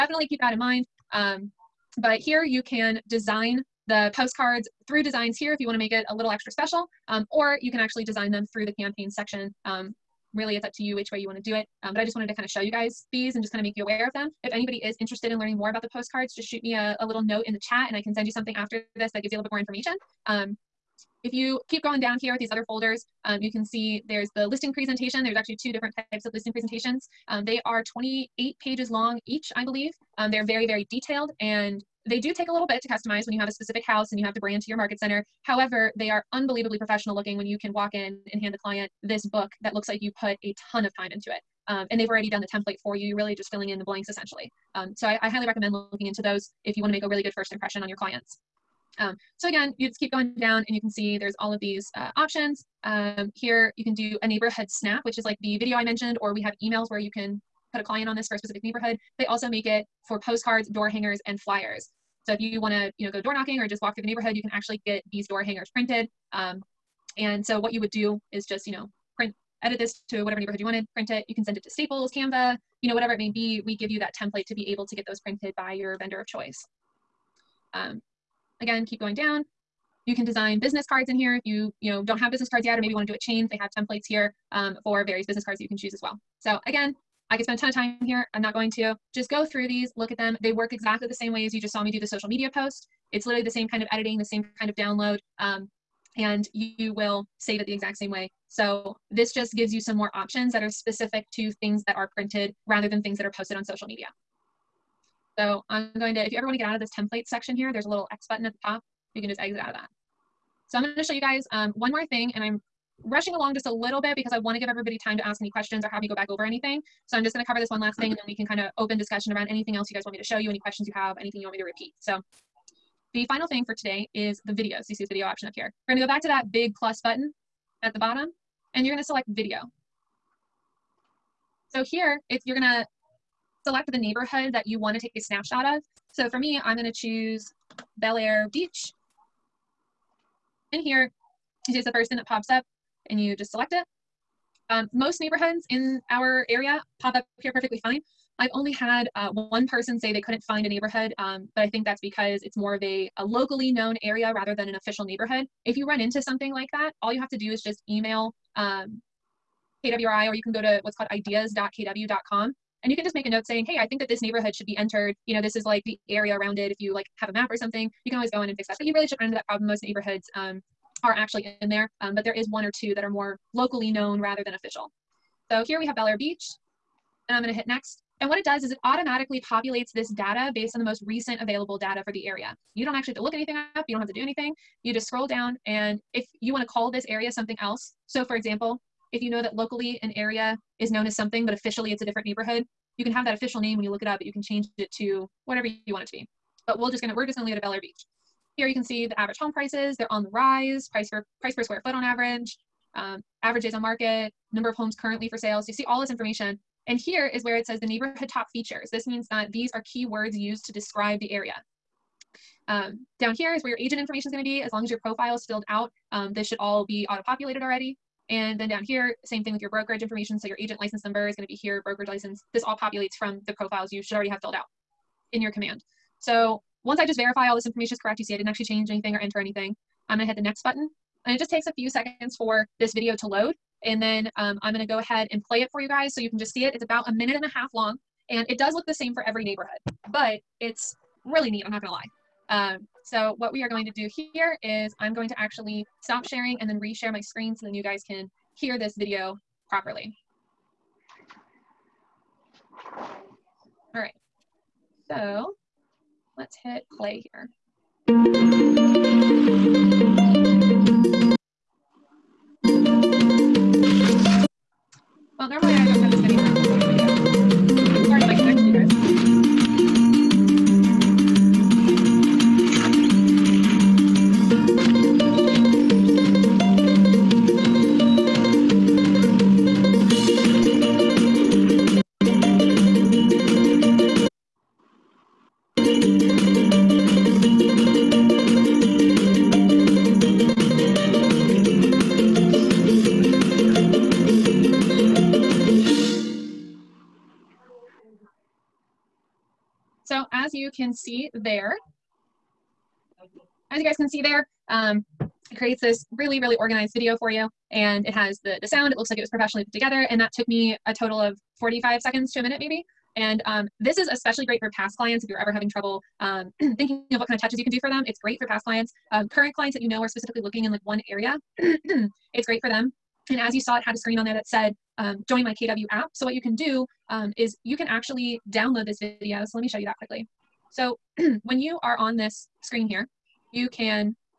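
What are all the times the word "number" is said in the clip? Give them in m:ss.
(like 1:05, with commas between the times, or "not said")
3:24, 3:41.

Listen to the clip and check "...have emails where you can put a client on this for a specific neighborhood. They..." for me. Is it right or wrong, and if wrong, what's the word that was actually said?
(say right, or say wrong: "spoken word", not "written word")
right.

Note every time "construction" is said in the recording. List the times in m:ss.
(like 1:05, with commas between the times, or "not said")
not said.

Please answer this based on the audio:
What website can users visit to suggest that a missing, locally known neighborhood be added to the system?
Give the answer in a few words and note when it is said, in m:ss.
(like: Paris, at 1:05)
ideas.kw.com, at 2:41.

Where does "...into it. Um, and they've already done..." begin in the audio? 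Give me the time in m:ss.
0:41.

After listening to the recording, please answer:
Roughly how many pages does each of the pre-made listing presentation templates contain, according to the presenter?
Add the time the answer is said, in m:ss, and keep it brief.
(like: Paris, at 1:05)
28, at 0:27.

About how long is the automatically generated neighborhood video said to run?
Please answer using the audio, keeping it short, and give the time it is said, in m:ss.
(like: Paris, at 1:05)
a minute and a half, at 3:57.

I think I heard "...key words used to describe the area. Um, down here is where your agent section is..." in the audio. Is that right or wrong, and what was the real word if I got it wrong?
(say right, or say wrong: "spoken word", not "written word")
wrong: "information", not "section".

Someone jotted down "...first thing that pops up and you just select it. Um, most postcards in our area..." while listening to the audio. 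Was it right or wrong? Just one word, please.
wrong.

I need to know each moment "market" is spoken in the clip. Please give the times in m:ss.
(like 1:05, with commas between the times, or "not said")
0:34, 3:23.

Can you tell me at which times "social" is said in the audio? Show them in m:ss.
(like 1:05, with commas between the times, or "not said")
1:32, 1:43.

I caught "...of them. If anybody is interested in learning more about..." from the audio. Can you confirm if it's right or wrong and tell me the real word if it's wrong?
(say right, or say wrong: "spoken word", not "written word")
right.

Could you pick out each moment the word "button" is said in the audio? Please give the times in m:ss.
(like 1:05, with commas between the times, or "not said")
1:48, 2:07, 3:50.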